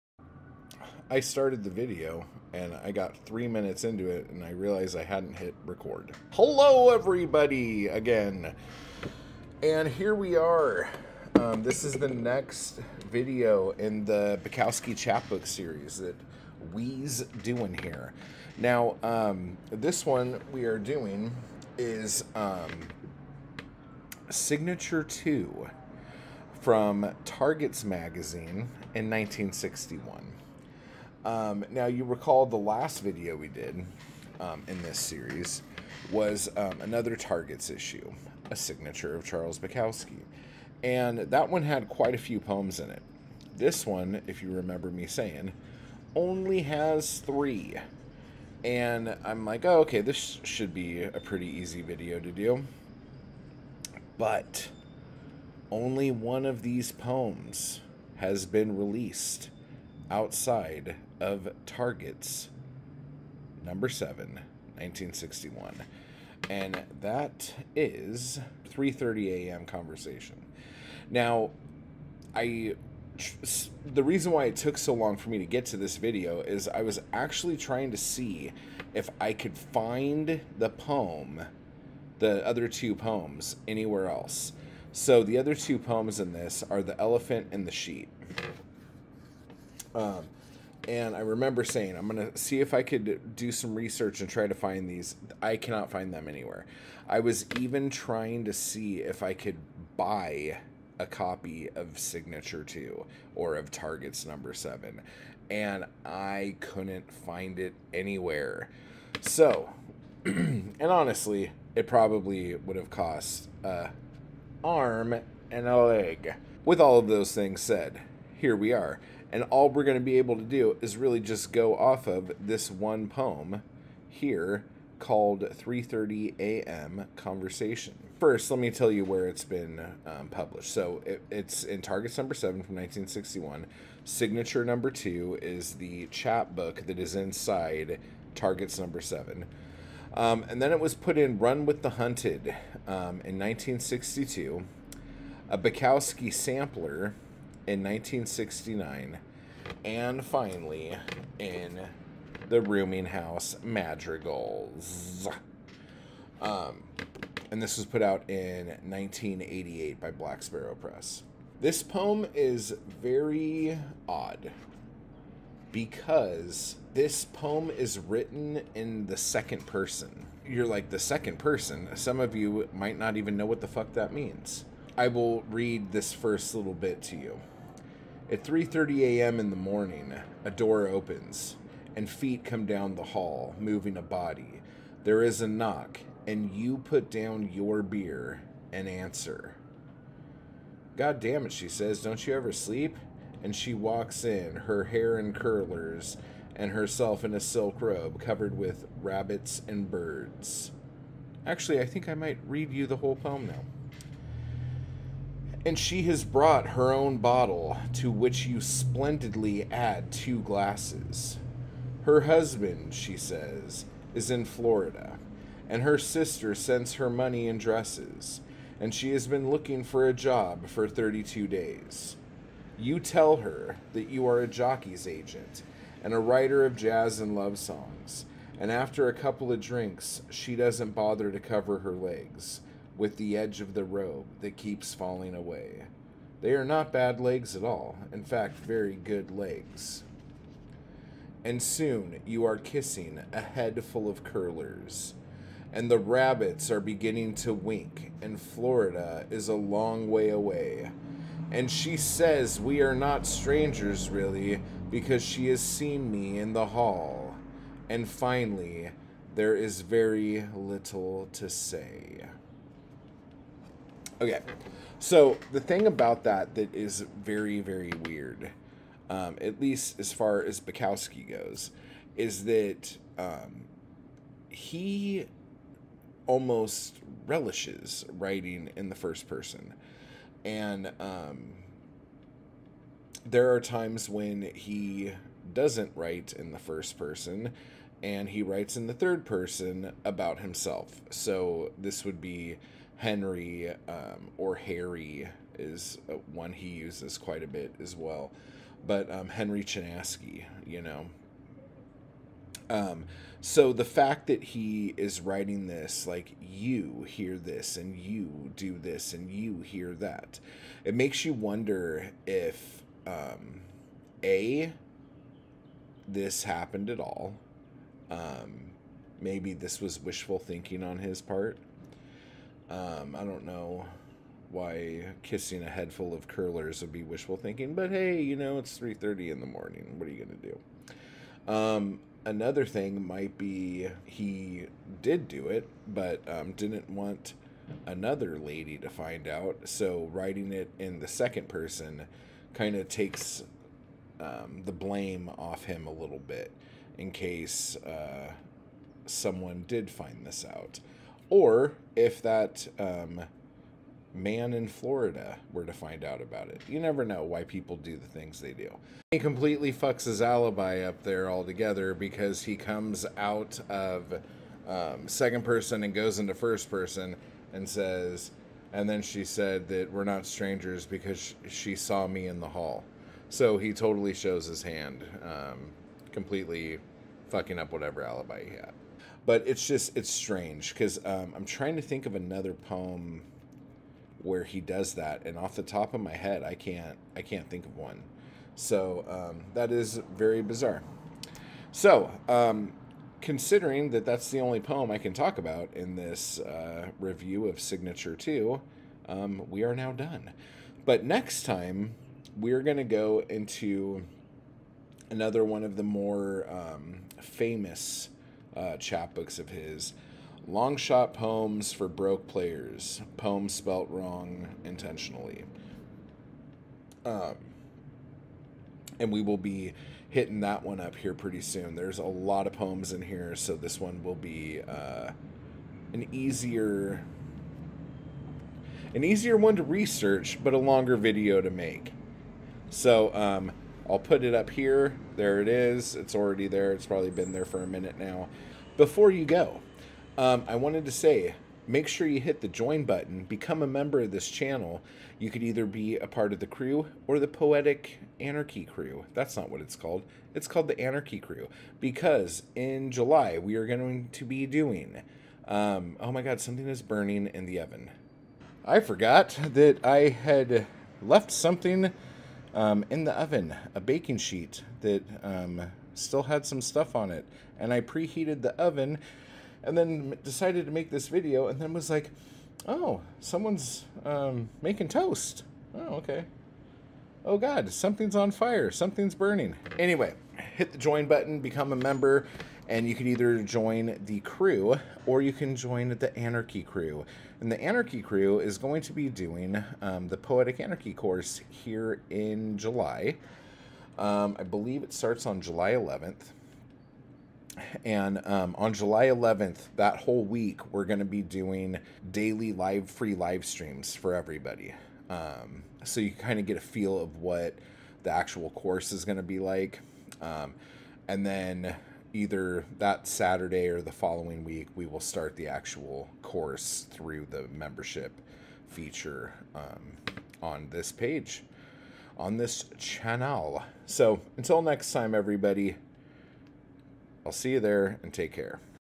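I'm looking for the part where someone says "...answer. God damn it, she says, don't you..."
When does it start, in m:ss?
3:08.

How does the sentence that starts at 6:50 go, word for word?
Long shot poems for broke players, poems spelt wrong intentionally.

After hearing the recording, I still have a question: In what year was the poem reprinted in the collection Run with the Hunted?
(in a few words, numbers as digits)
1962.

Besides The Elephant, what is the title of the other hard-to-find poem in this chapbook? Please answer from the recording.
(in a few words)
the Sheep.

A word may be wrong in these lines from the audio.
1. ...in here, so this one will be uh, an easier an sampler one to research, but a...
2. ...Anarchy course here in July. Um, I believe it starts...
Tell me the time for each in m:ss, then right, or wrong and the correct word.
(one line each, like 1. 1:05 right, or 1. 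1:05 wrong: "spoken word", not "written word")
1. 7:02 wrong: "easier", not "sampler"
2. 8:10 right.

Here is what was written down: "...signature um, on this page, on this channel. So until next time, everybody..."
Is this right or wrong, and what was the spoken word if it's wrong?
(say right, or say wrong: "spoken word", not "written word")
wrong: "feature", not "signature".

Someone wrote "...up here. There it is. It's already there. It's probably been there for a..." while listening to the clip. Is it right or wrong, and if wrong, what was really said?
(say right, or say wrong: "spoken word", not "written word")
right.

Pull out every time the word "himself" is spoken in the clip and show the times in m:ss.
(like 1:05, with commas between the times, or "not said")
4:50.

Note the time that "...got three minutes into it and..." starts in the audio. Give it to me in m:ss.
0:02.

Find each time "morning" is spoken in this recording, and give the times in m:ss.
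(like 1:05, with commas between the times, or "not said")
2:59, 5:29.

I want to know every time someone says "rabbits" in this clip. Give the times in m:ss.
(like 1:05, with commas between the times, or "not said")
3:19, 4:05.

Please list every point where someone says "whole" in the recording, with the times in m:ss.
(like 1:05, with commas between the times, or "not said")
3:22, 8:19.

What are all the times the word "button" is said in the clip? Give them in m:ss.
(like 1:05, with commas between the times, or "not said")
7:22, 8:01.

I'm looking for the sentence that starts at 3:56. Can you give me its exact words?
They are not bad legs at all, in fact, very good legs.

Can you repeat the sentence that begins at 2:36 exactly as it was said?
Um, and this was put out in 1988 by Black Sparrow Press.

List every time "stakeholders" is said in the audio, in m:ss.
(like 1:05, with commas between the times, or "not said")
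not said.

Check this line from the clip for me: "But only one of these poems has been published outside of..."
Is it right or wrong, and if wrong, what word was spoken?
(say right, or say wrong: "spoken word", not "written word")
wrong: "released", not "published".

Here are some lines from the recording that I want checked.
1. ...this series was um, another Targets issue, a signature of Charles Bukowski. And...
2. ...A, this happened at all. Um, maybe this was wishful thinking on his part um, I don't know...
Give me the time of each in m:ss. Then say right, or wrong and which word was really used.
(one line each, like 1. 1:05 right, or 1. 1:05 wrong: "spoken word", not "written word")
1. 0:34 right
2. 5:14 right.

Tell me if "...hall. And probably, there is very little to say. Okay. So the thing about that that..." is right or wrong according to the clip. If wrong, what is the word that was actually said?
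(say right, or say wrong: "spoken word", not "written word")
wrong: "finally", not "probably".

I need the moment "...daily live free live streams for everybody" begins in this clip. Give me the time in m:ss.
8:22.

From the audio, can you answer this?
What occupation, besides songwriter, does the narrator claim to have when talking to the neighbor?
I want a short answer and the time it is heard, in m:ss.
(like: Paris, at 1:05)
jockey's agent, at 3:44.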